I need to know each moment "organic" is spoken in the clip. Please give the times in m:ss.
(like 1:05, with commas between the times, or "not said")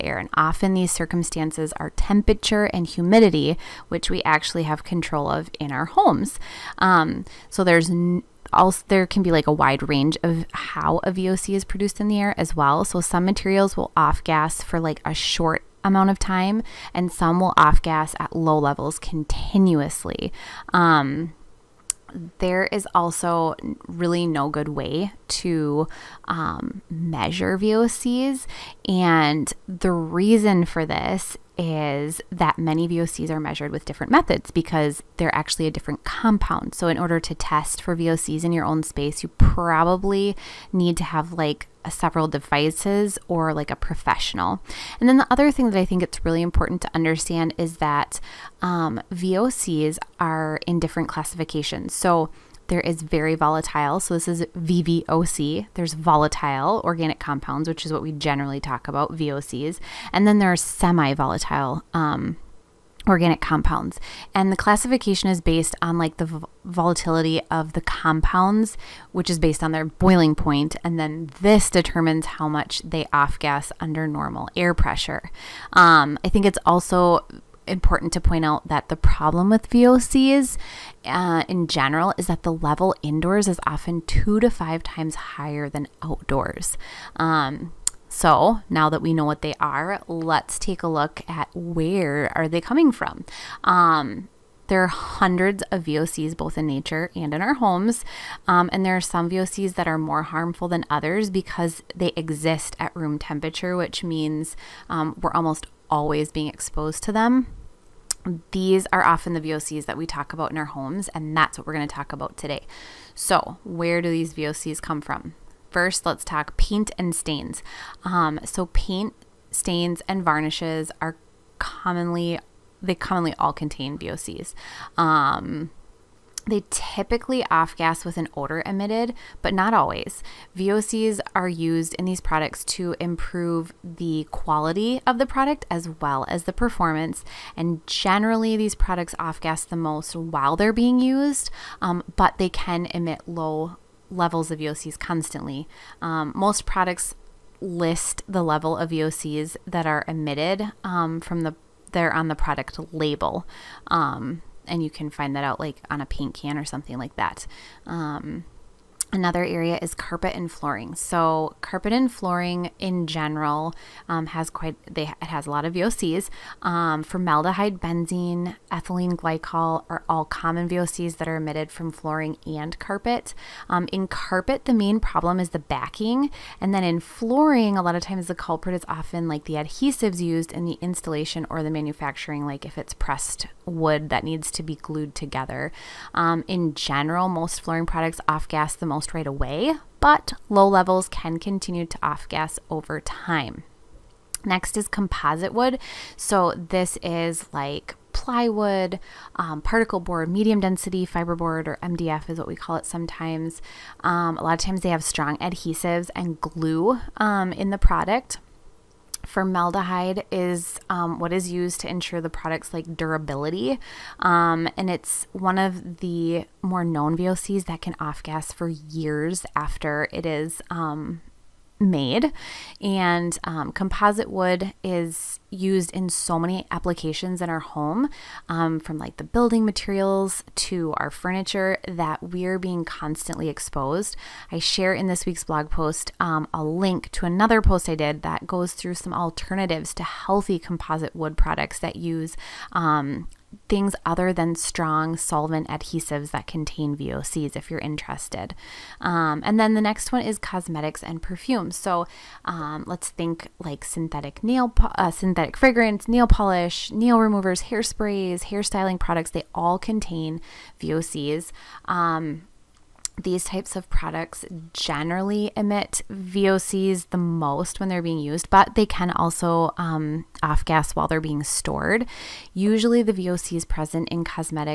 0:56, 1:03.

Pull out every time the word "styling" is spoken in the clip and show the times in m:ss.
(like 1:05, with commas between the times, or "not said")
4:18.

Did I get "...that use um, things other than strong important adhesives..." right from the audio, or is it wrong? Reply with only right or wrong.
wrong.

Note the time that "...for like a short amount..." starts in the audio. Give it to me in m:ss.
0:14.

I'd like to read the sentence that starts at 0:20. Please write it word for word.
Um, there is also really no good way to um, measure VOCs.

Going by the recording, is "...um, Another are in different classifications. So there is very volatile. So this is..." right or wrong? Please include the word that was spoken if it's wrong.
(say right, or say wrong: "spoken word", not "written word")
wrong: "VOCs", not "Another".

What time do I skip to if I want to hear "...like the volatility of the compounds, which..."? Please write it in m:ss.
1:05.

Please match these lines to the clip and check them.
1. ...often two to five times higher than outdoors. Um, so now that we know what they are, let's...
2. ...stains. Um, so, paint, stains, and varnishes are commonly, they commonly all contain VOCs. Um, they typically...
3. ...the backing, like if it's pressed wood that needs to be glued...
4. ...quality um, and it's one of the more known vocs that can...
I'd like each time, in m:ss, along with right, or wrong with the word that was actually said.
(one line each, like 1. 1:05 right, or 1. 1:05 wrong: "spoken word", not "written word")
1. 1:23 right
2. 1:57 right
3. 3:01 wrong: "manufacturing", not "backing"
4. 3:32 wrong: "durability", not "quality".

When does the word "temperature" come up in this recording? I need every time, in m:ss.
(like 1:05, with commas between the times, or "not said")
0:01, 1:43.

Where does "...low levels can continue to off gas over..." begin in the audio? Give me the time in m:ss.
3:10.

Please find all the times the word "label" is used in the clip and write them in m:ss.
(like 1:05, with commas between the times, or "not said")
2:32.